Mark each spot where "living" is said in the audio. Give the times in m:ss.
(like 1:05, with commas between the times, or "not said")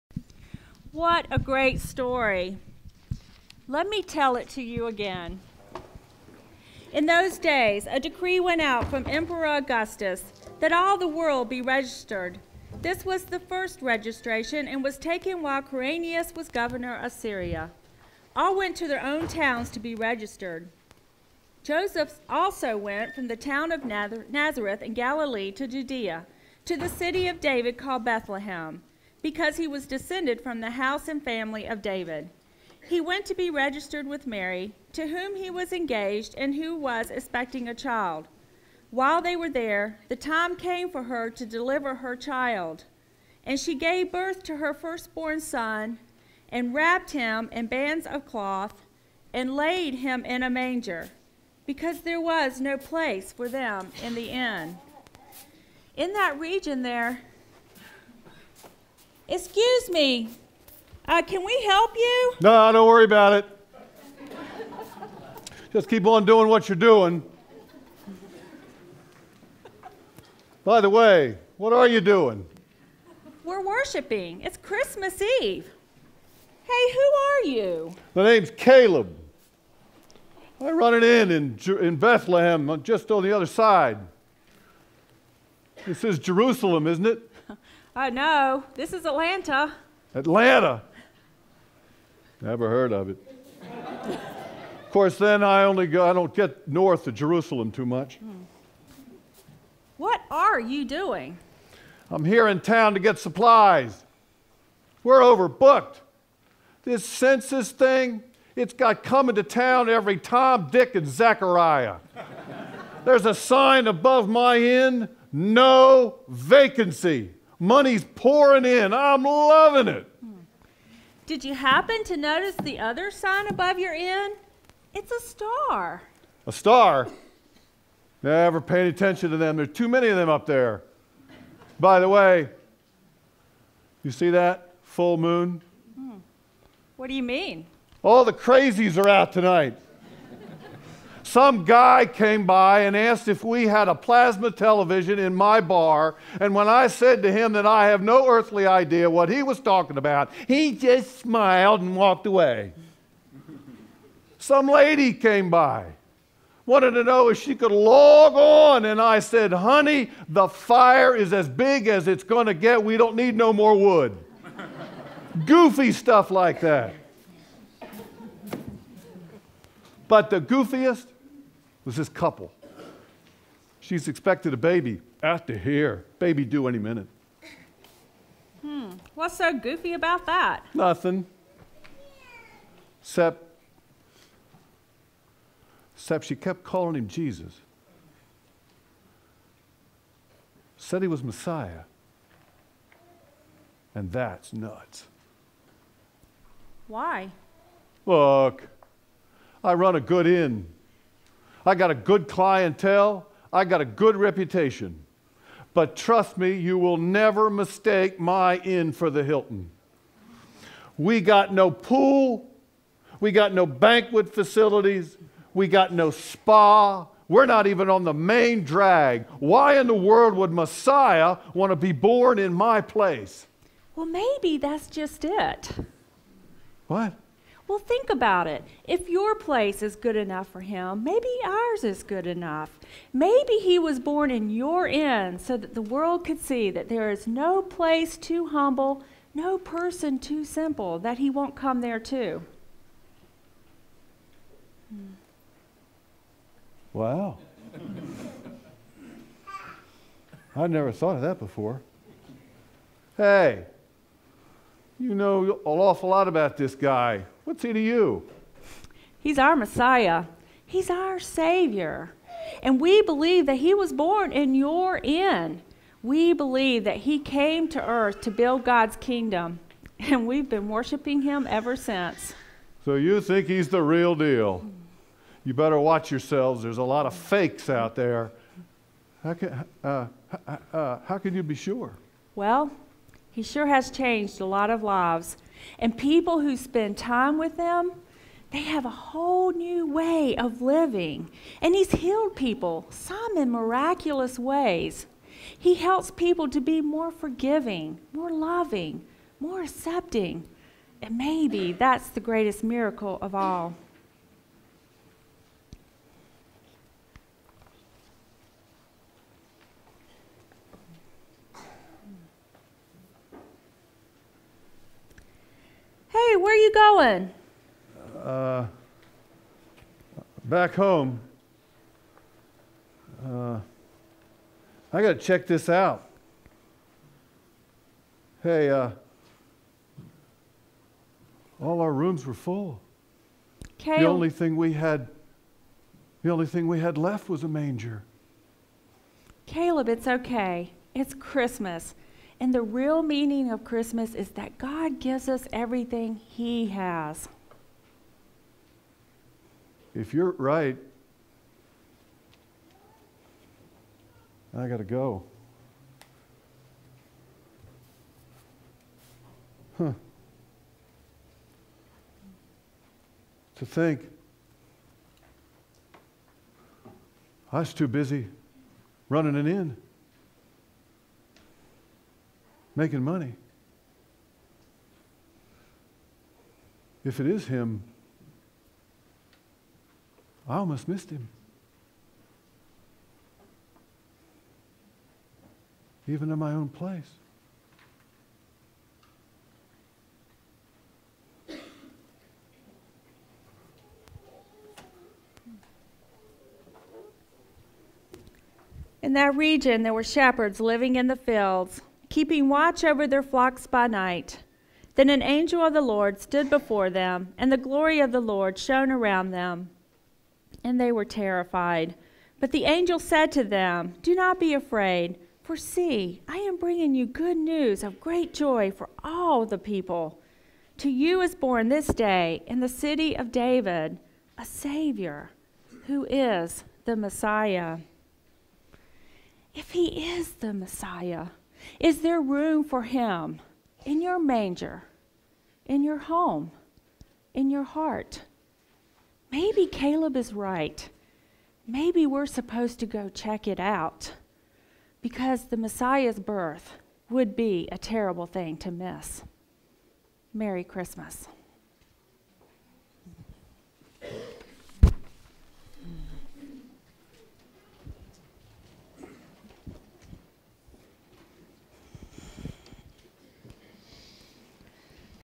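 4:50, 6:40.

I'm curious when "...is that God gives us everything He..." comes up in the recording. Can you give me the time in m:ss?
5:44.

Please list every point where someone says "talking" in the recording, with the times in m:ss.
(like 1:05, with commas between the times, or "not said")
2:29.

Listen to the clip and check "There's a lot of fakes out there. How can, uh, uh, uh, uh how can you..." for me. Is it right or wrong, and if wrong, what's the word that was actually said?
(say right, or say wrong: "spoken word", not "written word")
right.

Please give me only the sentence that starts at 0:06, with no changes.
In those days, a decree went out from Emperor Augustus that all the world be registered.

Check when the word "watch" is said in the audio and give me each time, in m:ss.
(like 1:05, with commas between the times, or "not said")
4:35, 6:42.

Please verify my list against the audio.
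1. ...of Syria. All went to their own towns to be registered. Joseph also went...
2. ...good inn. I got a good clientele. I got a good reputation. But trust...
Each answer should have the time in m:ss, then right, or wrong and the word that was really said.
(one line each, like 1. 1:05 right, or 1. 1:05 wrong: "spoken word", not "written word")
1. 0:16 right
2. 3:19 right.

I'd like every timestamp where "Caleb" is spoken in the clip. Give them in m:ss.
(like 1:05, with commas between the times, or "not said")
1:18, 5:39, 7:19.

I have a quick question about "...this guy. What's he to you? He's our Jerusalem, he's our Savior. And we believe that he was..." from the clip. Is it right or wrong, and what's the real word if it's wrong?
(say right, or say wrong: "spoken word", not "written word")
wrong: "Messiah", not "Jerusalem".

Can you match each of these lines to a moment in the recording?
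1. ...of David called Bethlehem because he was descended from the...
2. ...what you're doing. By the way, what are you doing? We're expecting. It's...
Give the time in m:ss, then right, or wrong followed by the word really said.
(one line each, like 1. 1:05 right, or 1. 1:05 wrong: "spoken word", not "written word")
1. 0:27 right
2. 1:06 wrong: "worshiping", not "expecting".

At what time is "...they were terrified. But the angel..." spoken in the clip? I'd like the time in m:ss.
6:50.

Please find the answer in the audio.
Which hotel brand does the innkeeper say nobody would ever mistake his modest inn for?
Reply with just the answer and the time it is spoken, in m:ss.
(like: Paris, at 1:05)
The Hilton, at 3:29.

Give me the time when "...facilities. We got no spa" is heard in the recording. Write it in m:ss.
3:34.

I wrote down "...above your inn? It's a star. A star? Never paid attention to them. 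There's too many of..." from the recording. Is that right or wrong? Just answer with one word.
right.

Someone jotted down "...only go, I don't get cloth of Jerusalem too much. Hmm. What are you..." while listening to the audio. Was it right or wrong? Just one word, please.
wrong.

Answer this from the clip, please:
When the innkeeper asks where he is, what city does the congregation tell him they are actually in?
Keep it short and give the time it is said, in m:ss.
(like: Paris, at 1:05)
Atlanta, at 1:28.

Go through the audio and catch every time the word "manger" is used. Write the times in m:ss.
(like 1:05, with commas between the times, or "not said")
0:50, 5:37, 7:14.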